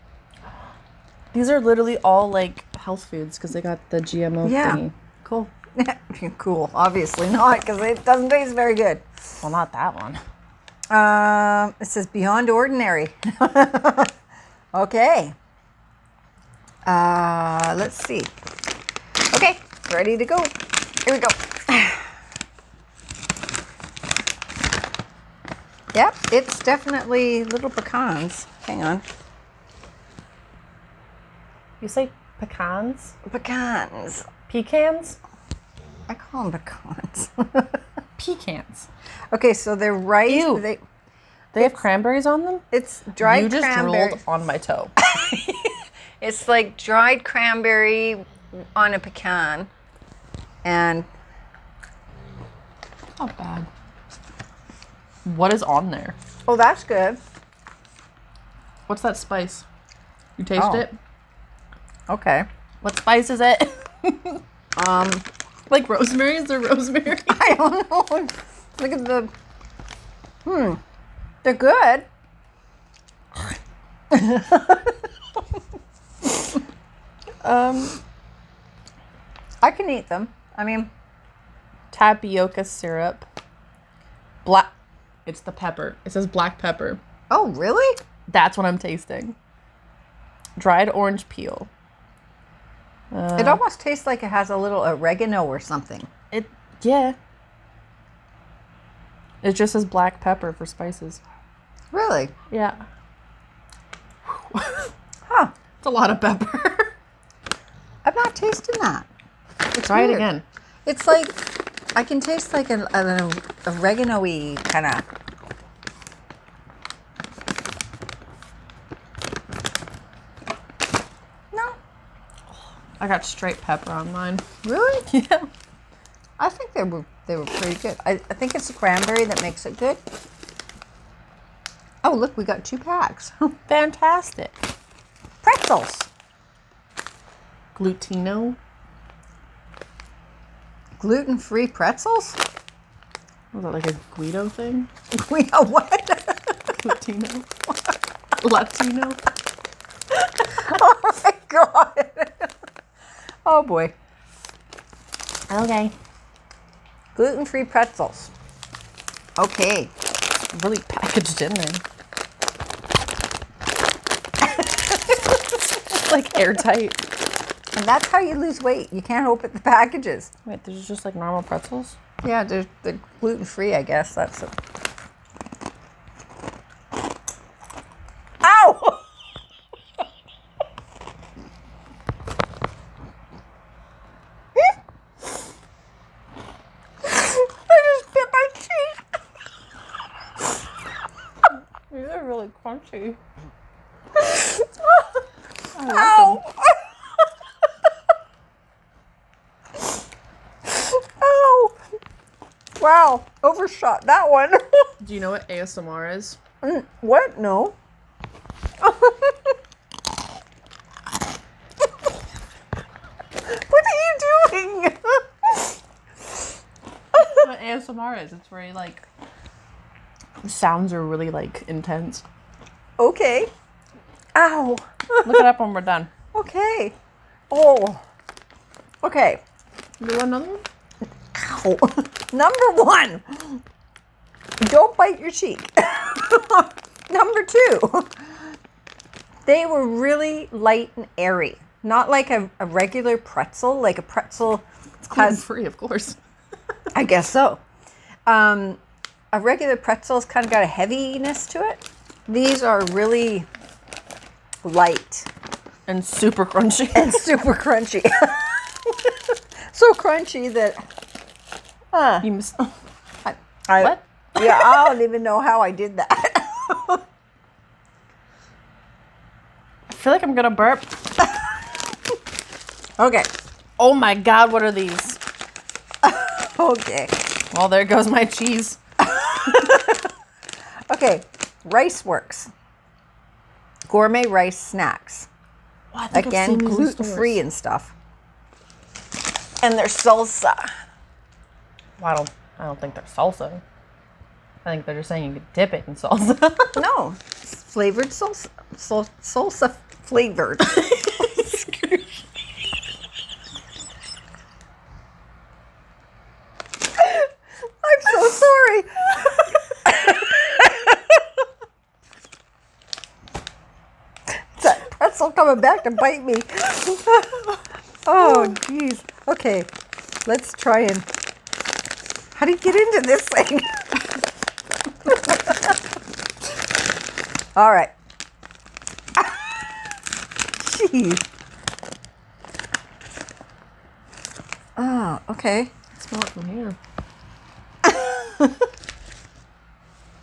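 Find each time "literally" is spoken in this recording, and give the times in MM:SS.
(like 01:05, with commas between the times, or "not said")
00:01.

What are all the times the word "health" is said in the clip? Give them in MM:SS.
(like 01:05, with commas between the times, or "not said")
00:02.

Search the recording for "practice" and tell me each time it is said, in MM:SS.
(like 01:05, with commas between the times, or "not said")
not said.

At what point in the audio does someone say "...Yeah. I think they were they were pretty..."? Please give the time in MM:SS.
02:05.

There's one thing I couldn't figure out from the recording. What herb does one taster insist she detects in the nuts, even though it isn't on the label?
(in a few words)
Oregano.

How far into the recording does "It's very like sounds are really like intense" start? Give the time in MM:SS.
03:38.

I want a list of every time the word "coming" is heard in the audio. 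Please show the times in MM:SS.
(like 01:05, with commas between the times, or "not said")
05:15.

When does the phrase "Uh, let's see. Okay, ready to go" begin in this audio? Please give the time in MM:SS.
00:16.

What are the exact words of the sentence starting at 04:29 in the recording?
I feel like I'm gonna burp.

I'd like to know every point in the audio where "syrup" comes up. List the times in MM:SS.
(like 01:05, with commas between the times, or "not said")
01:22.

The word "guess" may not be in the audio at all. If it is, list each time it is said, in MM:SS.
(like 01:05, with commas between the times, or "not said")
02:53, 04:07.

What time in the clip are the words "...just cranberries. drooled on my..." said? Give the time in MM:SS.
00:43.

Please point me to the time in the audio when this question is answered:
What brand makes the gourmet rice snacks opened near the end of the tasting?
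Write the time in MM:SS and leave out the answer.
04:41.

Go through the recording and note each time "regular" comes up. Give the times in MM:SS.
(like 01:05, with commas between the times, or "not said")
04:02, 04:09.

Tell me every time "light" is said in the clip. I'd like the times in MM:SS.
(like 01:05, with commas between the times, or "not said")
04:00, 04:14.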